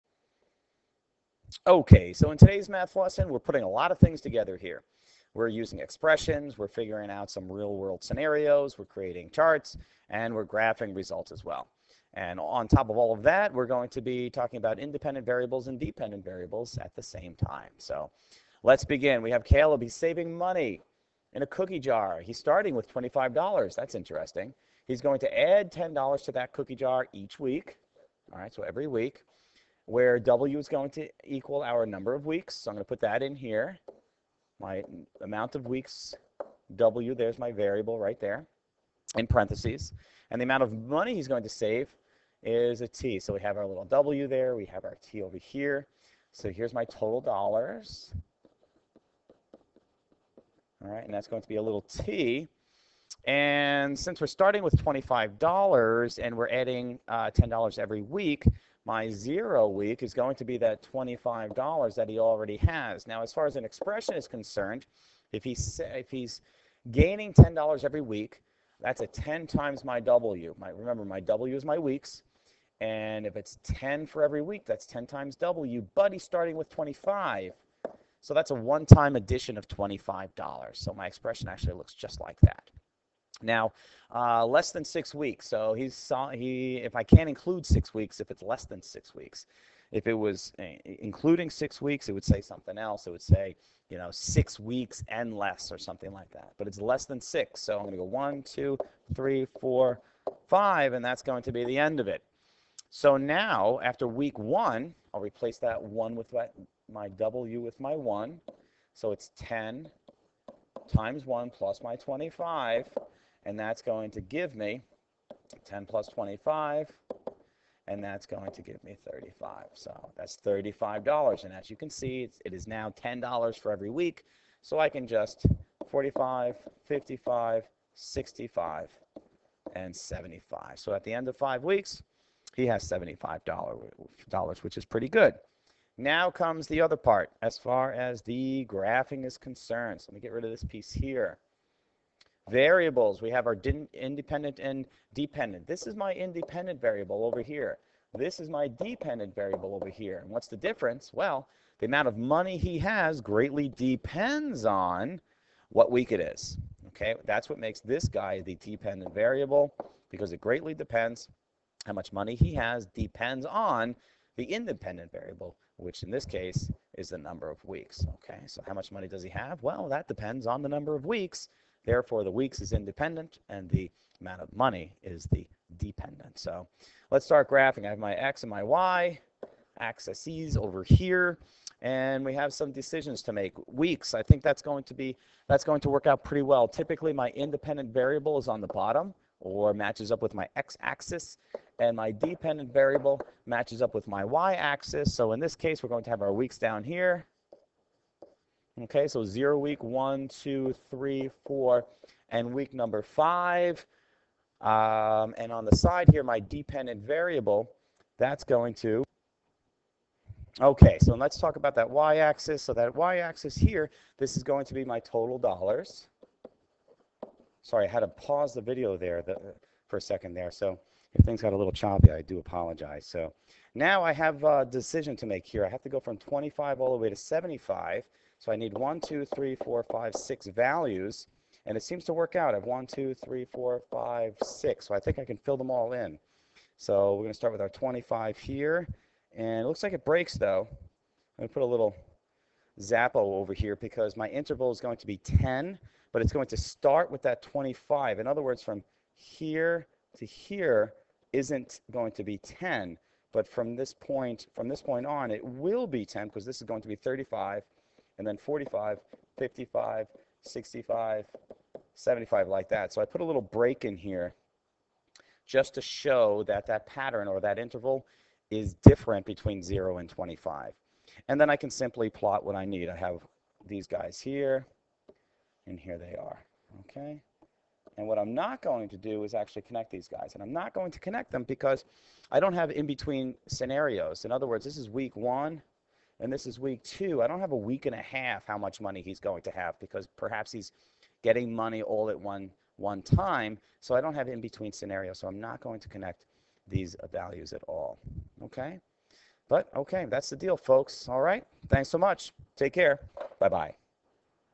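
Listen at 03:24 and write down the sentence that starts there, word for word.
Um, and on the side here, my dependent variable, that's going to, okay, so let's talk about that y-axis.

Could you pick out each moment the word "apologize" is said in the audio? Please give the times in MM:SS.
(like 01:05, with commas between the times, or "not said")
03:42.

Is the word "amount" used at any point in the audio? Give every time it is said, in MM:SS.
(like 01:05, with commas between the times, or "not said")
00:35, 00:40, 02:31, 02:54.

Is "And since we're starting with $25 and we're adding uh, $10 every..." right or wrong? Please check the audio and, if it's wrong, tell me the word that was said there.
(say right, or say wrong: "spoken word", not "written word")
right.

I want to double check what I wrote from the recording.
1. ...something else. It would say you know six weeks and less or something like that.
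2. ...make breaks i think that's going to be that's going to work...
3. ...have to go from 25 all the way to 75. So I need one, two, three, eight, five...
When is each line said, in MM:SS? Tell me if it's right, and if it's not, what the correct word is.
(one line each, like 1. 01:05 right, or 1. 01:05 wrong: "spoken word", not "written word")
1. 01:32 right
2. 03:03 wrong: "weeks", not "breaks"
3. 03:45 wrong: "four", not "eight".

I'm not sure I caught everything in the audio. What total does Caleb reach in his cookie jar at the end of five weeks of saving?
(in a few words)
$75.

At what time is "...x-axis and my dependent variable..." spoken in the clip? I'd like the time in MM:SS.
03:10.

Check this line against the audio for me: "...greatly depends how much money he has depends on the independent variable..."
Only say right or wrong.
right.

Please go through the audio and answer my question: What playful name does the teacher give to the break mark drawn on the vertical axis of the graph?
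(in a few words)
Zappo.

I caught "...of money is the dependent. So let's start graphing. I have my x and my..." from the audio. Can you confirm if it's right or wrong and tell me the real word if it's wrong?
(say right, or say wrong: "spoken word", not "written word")
right.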